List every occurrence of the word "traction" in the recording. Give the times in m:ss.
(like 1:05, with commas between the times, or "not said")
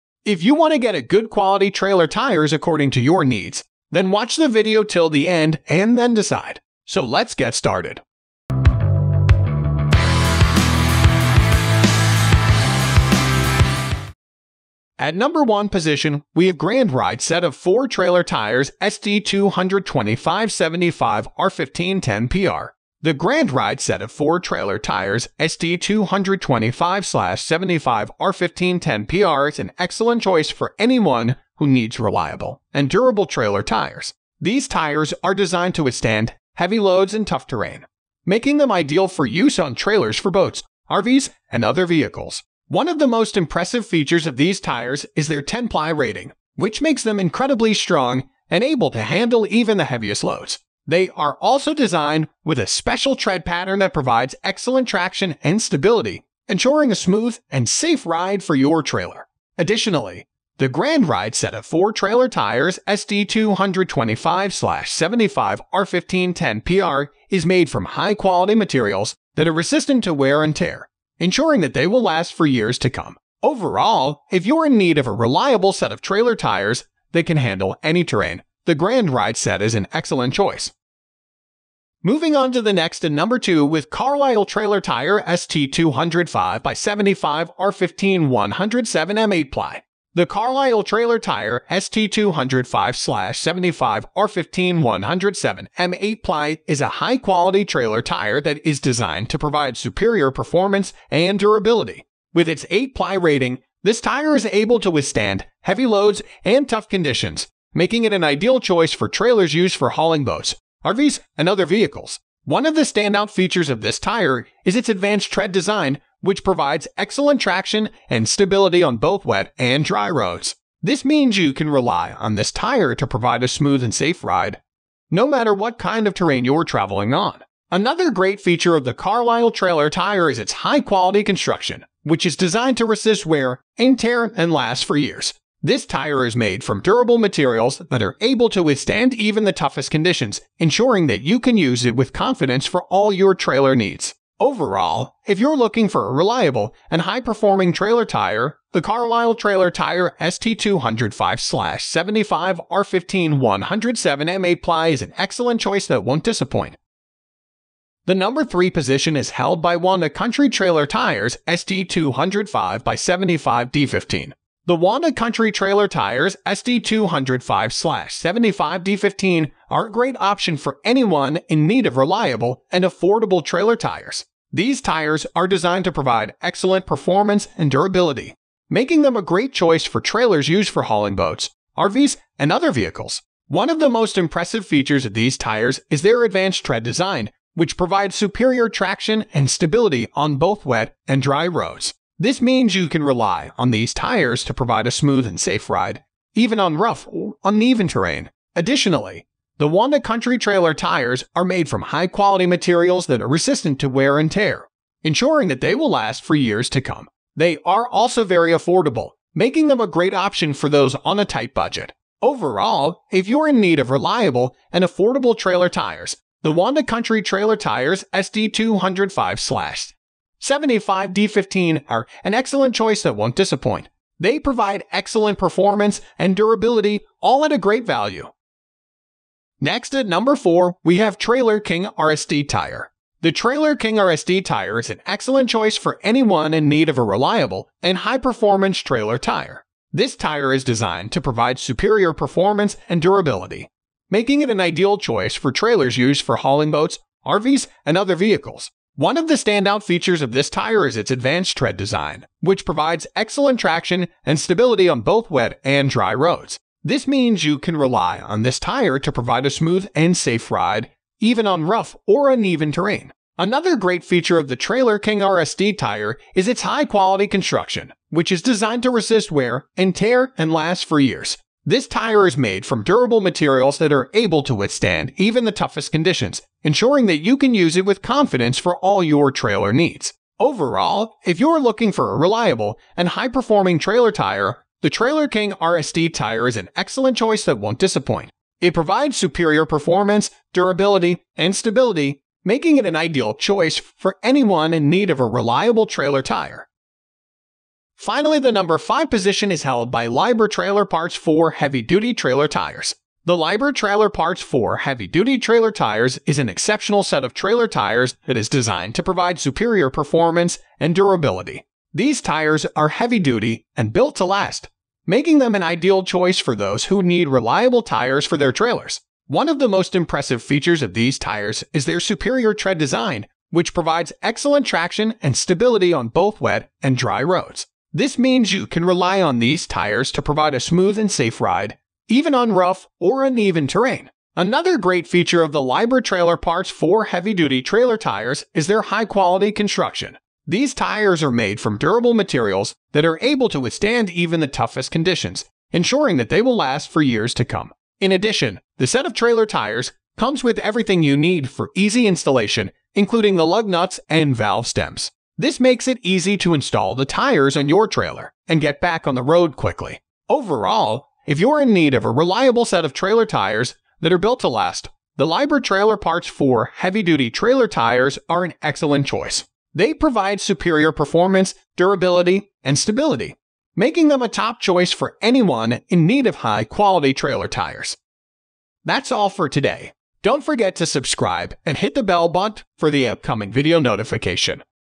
0:54, 1:57, 3:08, 4:13, 5:24.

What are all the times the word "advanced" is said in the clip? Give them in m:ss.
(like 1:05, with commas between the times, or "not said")
1:54, 3:06, 4:11.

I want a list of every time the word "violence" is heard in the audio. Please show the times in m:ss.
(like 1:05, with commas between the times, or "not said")
not said.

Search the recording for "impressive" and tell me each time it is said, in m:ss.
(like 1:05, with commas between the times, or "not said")
0:43, 3:04, 5:19.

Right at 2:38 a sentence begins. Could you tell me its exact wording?
The number 3 position is held by Wanda Country Trailer Tires ST205 by 75 D15.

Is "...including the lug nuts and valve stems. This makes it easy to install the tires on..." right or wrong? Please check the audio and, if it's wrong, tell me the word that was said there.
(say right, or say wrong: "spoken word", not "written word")
right.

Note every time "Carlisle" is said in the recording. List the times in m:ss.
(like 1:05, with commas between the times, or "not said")
1:23, 1:30, 2:08, 2:28.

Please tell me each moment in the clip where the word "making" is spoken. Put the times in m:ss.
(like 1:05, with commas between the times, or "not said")
0:38, 1:47, 2:58, 3:29, 4:04, 4:52, 5:15, 6:13.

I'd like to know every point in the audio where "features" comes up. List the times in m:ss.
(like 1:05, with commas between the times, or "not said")
0:43, 1:53, 2:08, 3:04, 4:09, 4:24, 5:20, 5:35.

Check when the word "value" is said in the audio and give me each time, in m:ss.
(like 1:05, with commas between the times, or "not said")
3:47.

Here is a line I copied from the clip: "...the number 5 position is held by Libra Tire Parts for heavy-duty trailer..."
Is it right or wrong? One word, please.
wrong.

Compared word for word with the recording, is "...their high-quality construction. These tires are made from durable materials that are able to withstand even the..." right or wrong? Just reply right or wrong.
right.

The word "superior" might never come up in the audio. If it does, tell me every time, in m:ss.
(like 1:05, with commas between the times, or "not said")
1:39, 3:08, 4:01, 4:49, 5:09, 5:21, 6:10.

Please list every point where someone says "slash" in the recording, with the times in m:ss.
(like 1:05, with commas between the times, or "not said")
3:39.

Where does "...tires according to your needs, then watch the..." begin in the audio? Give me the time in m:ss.
0:02.